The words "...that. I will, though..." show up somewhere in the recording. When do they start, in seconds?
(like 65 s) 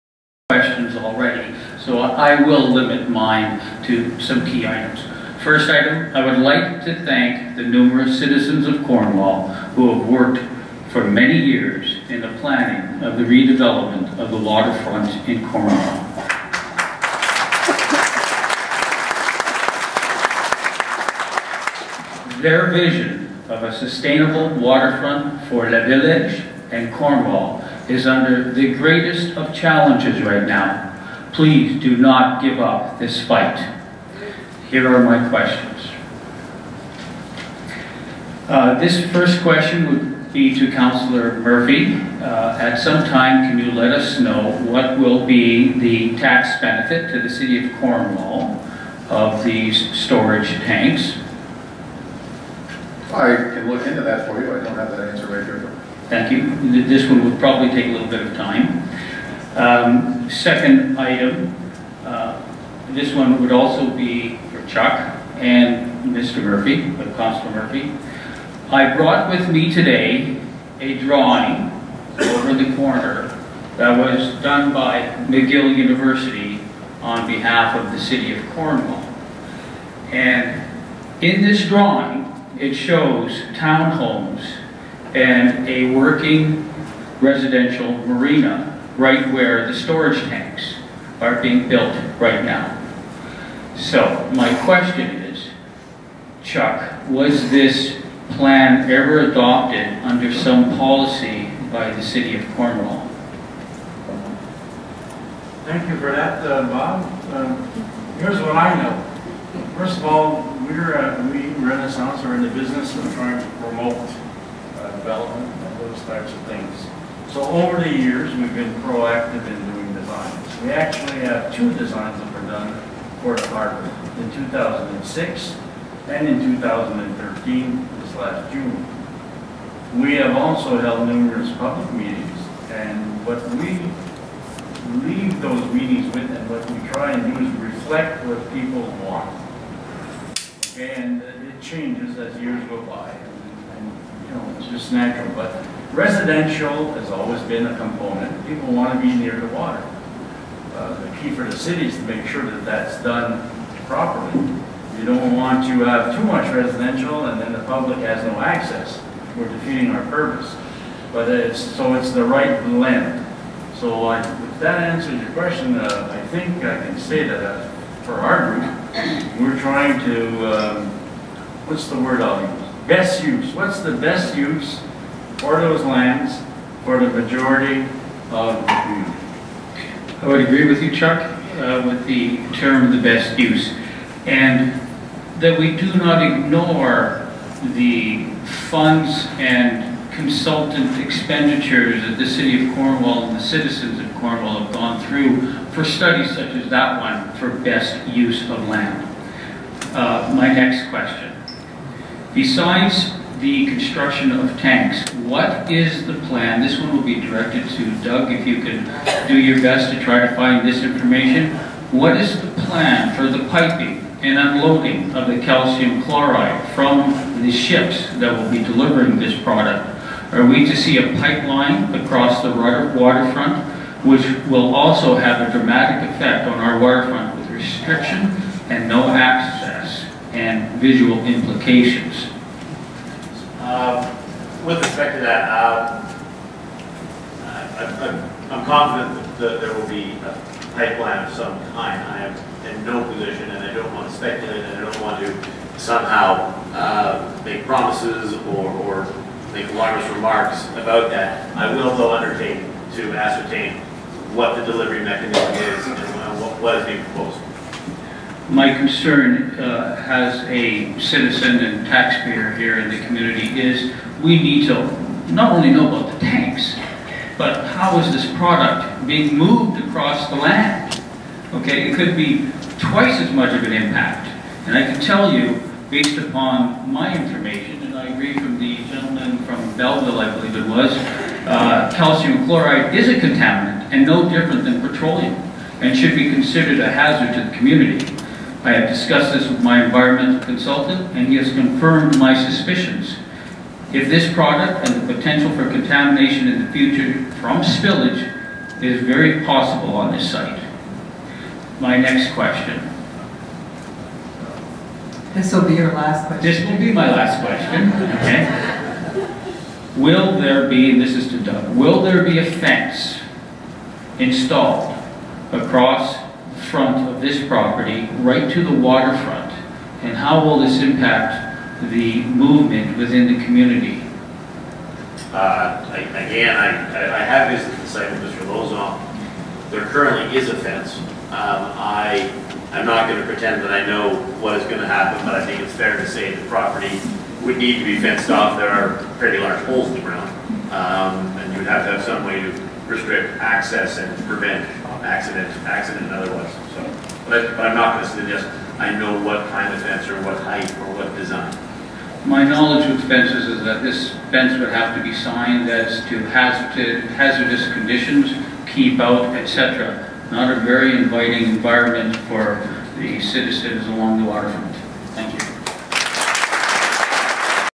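251 s.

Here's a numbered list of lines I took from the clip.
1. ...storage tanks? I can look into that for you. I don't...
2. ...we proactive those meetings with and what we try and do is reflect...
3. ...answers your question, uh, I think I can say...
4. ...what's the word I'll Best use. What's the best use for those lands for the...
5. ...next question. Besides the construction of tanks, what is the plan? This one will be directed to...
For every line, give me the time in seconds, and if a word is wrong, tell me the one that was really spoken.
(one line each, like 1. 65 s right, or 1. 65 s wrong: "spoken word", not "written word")
1. 49 s right
2. 133 s wrong: "leave", not "proactive"
3. 164 s right
4. 171 s right
5. 200 s right.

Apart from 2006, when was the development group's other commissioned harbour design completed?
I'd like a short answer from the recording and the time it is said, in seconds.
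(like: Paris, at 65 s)
2013, at 126 s.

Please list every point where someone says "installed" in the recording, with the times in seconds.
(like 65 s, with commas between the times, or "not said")
314 s.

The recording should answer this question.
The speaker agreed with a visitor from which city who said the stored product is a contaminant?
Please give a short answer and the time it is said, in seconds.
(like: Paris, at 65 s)
Belleville, at 279 s.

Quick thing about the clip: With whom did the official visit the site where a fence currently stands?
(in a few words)
Mr. Lauzon.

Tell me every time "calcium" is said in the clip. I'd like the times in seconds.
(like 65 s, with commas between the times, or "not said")
215 s, 281 s.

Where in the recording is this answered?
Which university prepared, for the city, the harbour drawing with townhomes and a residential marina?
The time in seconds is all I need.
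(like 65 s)
75 s.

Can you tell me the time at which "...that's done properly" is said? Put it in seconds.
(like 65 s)
152 s.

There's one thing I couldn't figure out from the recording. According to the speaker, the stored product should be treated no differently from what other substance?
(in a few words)
petroleum.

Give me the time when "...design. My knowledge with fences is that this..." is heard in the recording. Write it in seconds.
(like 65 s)
351 s.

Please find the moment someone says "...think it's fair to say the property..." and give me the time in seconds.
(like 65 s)
335 s.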